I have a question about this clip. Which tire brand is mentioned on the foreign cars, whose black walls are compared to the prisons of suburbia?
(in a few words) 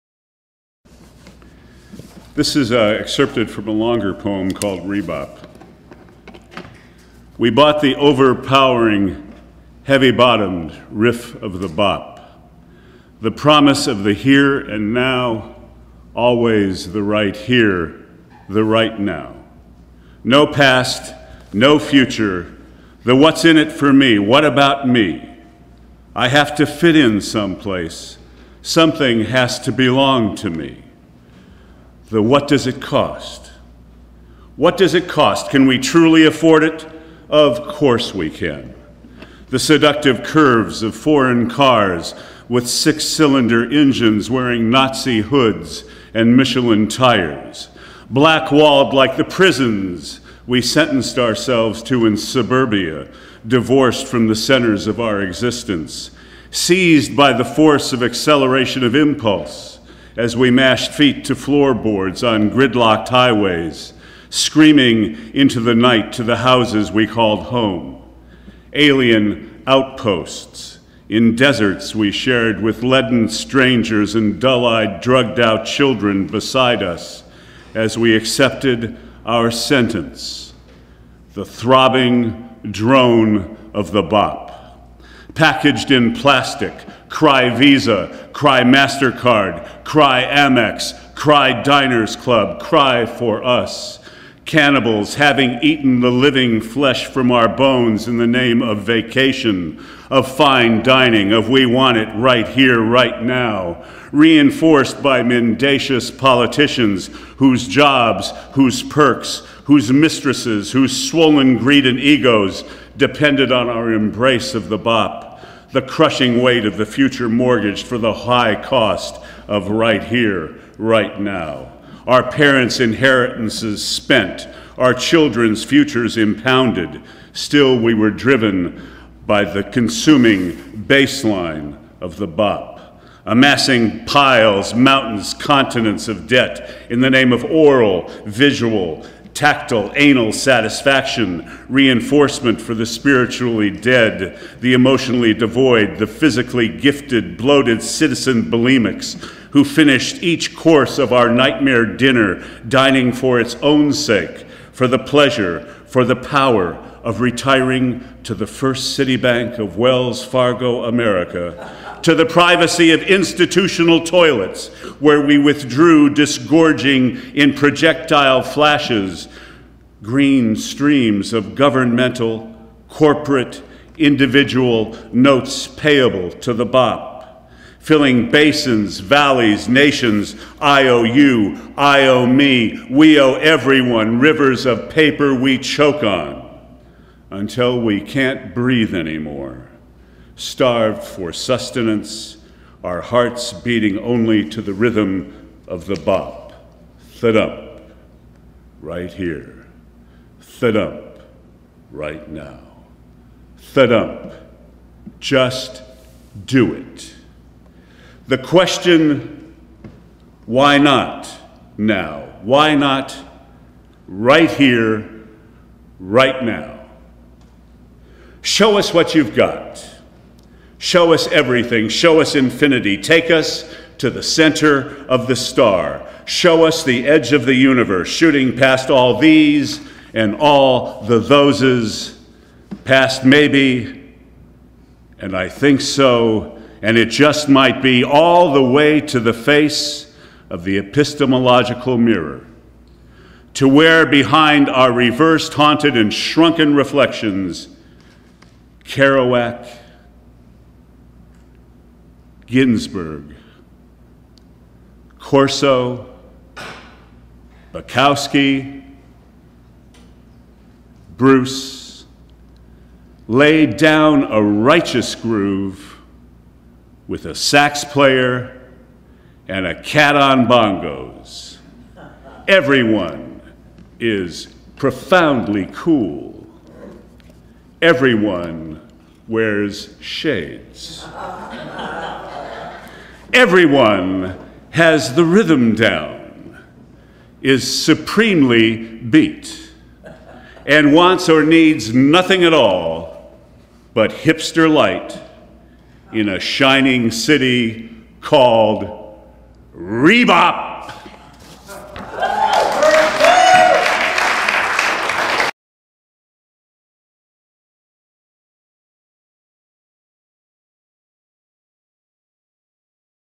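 Michelin.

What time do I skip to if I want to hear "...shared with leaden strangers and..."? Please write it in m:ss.
1:12.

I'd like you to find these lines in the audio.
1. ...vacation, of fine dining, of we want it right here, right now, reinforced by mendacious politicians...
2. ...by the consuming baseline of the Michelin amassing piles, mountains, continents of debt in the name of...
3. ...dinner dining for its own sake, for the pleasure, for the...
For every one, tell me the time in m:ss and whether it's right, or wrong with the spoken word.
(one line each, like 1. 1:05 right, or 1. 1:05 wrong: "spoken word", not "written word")
1. 1:38 right
2. 2:09 wrong: "BOP", not "Michelin"
3. 2:31 right.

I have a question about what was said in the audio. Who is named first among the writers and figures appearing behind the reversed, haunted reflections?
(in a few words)
Kerouac.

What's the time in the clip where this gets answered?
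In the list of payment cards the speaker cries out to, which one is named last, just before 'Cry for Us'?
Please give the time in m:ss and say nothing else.
1:31.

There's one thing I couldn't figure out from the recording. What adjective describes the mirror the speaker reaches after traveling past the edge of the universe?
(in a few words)
epistemological.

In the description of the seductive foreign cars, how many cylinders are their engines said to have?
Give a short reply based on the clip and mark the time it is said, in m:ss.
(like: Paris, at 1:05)
6, at 0:42.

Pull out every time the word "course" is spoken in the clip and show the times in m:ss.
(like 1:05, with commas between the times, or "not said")
0:37, 2:30.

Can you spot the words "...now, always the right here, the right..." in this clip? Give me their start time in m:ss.
0:14.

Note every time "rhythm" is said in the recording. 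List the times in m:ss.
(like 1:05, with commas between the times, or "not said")
3:14, 4:45.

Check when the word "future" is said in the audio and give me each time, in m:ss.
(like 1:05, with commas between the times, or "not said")
0:21, 1:56, 2:05.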